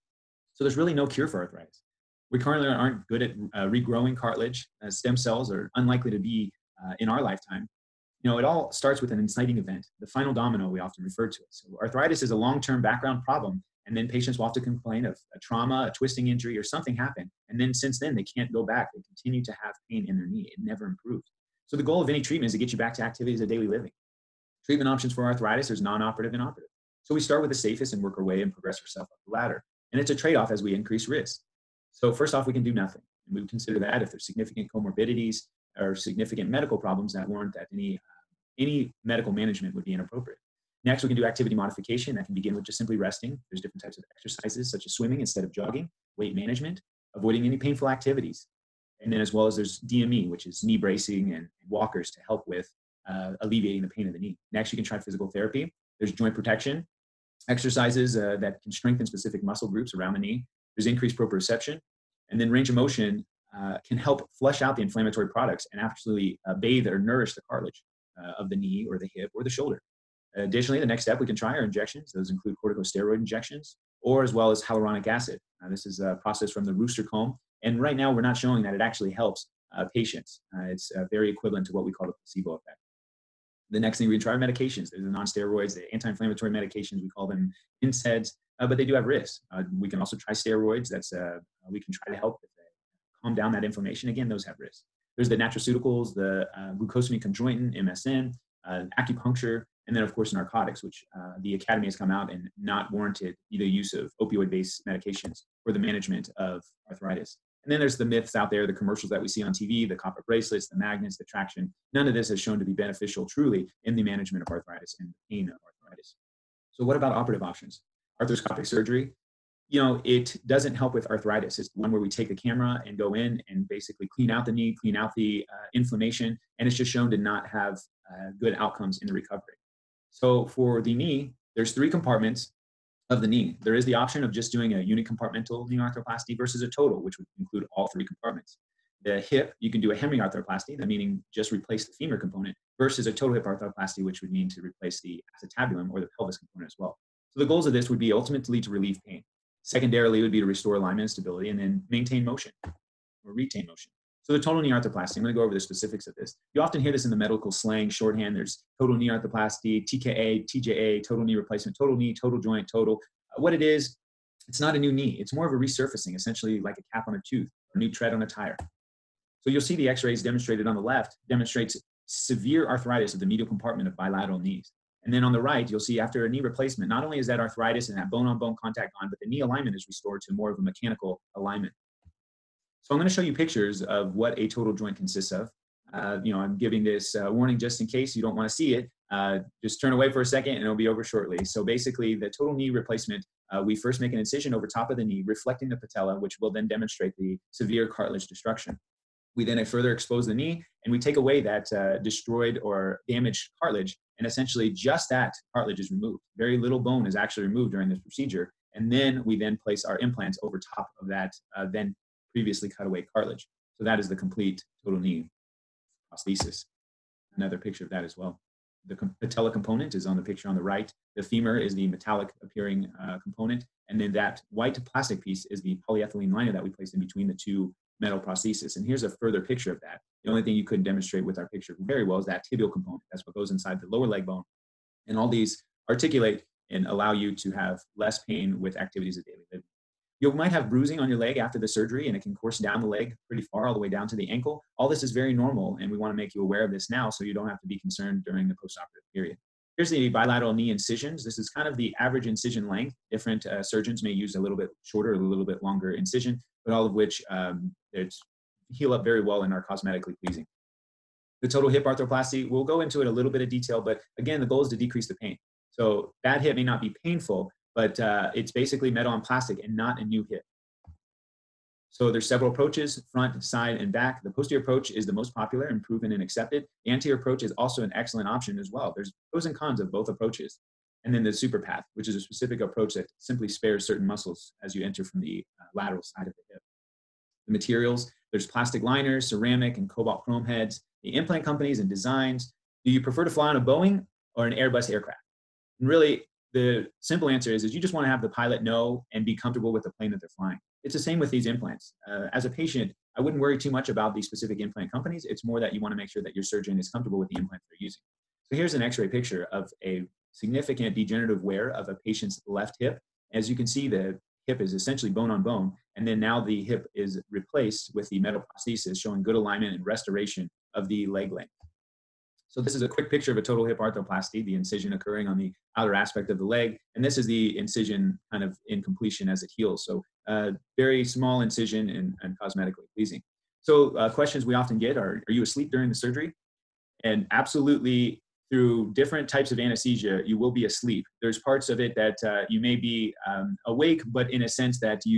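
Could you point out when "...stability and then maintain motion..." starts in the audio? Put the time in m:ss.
2:31.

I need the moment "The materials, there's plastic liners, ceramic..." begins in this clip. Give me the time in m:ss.
4:47.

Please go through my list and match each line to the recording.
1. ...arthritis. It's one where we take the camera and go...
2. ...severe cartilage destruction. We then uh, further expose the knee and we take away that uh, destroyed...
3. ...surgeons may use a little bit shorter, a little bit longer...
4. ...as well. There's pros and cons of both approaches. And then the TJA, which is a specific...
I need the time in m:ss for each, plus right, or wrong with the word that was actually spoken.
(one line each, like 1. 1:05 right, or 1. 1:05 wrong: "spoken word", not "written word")
1. 2:01 right
2. 3:17 right
3. 4:13 right
4. 4:38 wrong: "SuperPATH", not "TJA".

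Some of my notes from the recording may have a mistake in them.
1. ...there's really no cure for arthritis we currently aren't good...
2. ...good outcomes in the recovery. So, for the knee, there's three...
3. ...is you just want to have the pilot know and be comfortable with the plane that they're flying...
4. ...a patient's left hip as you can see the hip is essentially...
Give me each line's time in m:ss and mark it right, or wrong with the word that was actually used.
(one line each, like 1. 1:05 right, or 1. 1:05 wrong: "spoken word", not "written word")
1. 0:00 right
2. 2:08 right
3. 4:57 right
4. 5:11 right.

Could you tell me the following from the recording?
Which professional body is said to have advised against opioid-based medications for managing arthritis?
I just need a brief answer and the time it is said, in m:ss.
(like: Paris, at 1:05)
the academy, at 1:41.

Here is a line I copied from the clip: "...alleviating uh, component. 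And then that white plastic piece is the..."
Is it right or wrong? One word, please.
wrong.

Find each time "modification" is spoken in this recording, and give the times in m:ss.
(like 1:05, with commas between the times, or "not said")
0:41.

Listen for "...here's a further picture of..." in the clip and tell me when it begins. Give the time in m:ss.
3:48.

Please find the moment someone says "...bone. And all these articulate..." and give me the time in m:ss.
3:54.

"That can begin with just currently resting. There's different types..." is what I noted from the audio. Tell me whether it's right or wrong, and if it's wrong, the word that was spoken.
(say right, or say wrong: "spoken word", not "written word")
wrong: "simply", not "currently".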